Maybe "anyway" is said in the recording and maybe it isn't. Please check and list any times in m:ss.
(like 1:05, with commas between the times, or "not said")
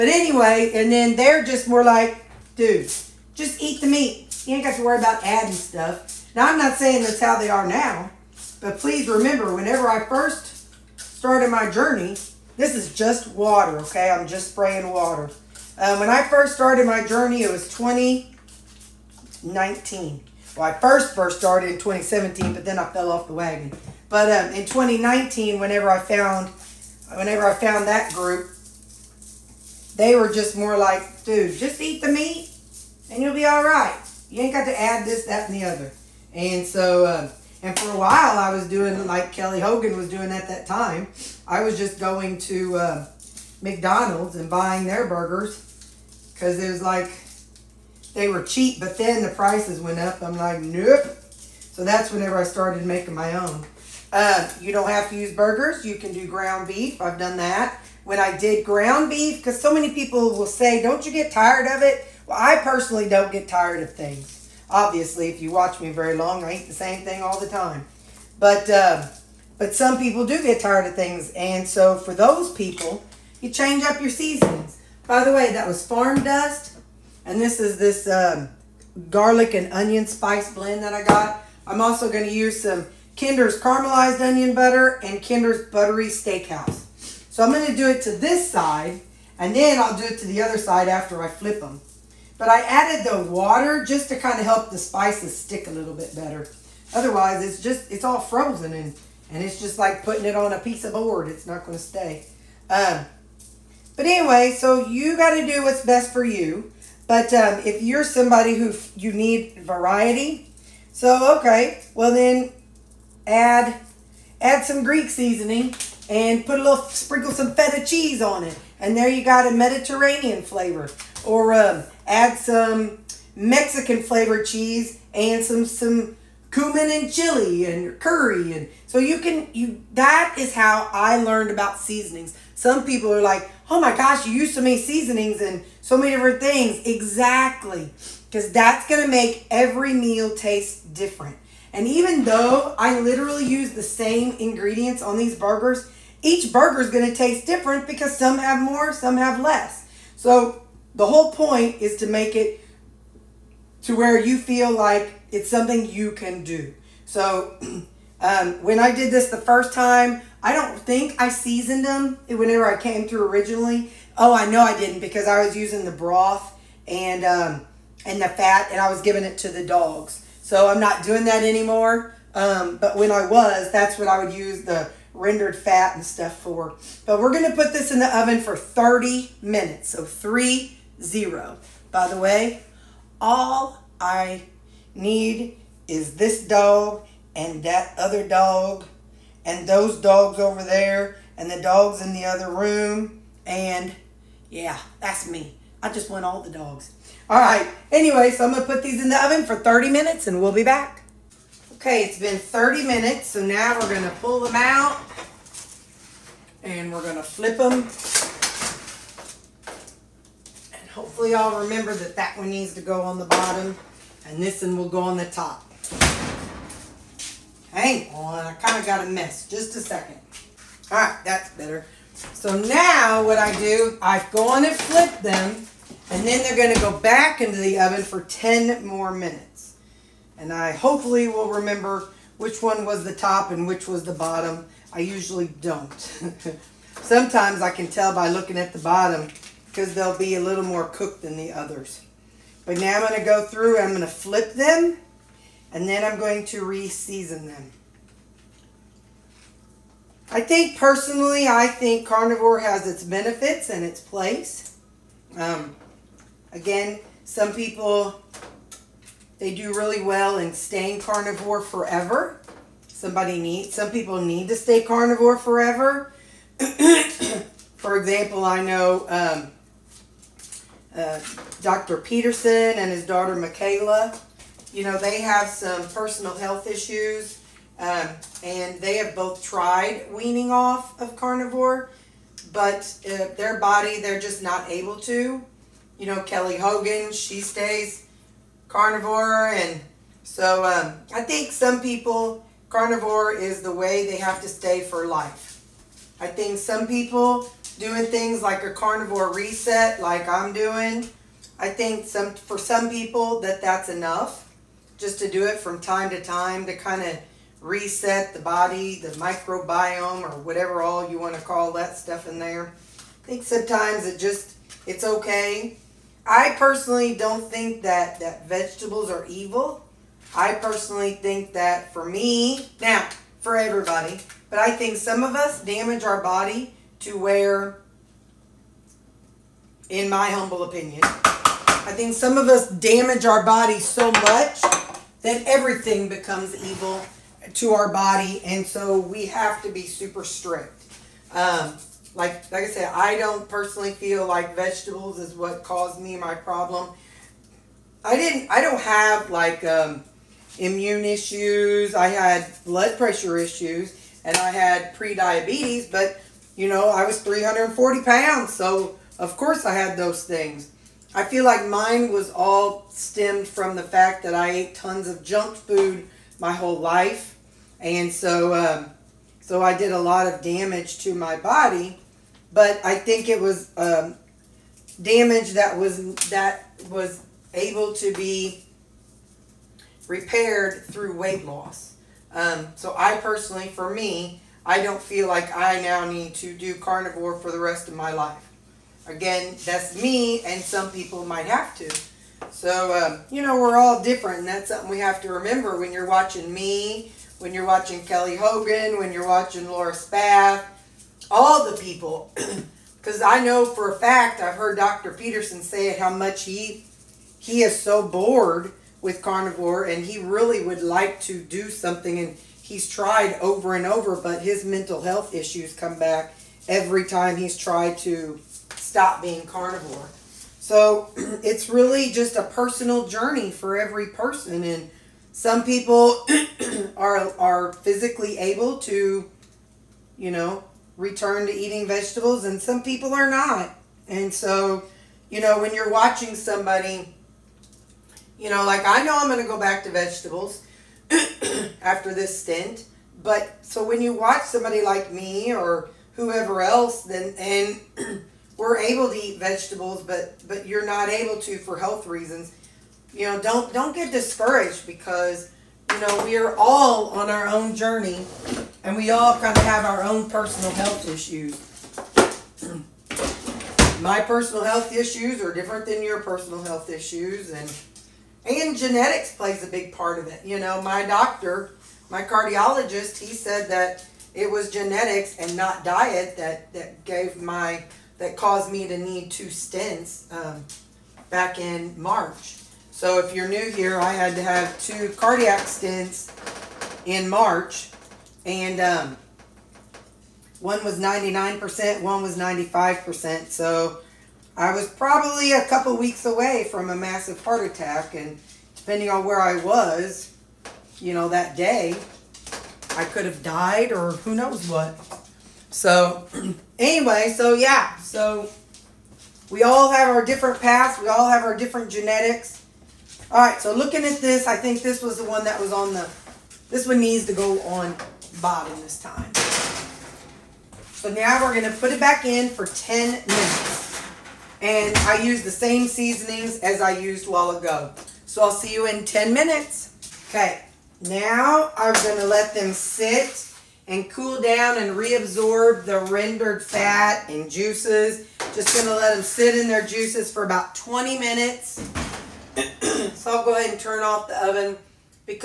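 0:00, 1:44, 3:17, 8:26.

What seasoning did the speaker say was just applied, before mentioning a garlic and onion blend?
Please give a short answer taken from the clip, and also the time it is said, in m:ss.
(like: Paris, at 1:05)
farm dust, at 1:15.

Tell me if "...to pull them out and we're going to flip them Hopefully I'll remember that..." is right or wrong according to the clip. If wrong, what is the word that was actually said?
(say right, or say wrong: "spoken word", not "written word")
right.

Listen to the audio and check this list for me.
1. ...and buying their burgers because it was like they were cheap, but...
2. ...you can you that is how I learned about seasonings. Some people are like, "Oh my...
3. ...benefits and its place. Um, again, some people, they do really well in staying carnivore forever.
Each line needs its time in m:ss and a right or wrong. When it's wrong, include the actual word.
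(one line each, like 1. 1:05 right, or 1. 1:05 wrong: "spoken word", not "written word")
1. 0:44 right
2. 2:08 right
3. 4:13 right.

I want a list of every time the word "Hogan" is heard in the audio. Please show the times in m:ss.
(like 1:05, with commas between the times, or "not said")
0:39, 4:46, 6:38.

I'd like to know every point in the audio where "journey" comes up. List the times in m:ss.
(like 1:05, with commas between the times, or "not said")
0:11, 0:17, 7:03, 7:37.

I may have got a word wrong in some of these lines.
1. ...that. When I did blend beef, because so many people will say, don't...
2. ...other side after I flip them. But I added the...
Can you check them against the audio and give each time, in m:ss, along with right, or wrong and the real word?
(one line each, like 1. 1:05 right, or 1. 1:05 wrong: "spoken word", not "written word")
1. 0:57 wrong: "ground", not "blend"
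2. 1:30 right.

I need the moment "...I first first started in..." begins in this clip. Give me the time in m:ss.
0:20.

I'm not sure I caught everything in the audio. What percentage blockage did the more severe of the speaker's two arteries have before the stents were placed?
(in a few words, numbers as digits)
99%.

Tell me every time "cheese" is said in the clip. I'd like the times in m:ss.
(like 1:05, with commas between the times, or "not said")
1:57, 2:04.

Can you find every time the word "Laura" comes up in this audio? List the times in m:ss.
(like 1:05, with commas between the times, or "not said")
6:39.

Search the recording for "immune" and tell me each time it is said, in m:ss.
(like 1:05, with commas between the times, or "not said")
5:50.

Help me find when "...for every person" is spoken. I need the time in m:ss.
7:03.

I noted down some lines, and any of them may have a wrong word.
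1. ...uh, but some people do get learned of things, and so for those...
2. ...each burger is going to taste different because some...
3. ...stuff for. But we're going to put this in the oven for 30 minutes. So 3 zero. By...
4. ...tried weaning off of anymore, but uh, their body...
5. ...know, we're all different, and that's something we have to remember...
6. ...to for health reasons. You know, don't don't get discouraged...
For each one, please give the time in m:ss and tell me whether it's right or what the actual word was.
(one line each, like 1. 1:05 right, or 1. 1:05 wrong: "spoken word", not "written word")
1. 1:08 wrong: "tired", not "learned"
2. 2:26 right
3. 2:56 right
4. 4:39 wrong: "carnivore", not "anymore"
5. 6:33 right
6. 7:31 right.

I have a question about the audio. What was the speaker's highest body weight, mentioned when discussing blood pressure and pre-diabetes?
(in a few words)
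340 pounds.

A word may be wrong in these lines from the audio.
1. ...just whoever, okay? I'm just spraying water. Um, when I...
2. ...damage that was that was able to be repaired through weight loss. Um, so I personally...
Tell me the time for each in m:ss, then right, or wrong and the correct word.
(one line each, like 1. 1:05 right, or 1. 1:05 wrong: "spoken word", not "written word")
1. 0:12 wrong: "water", not "whoever"
2. 6:14 right.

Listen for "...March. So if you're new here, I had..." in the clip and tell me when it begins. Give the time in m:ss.
8:02.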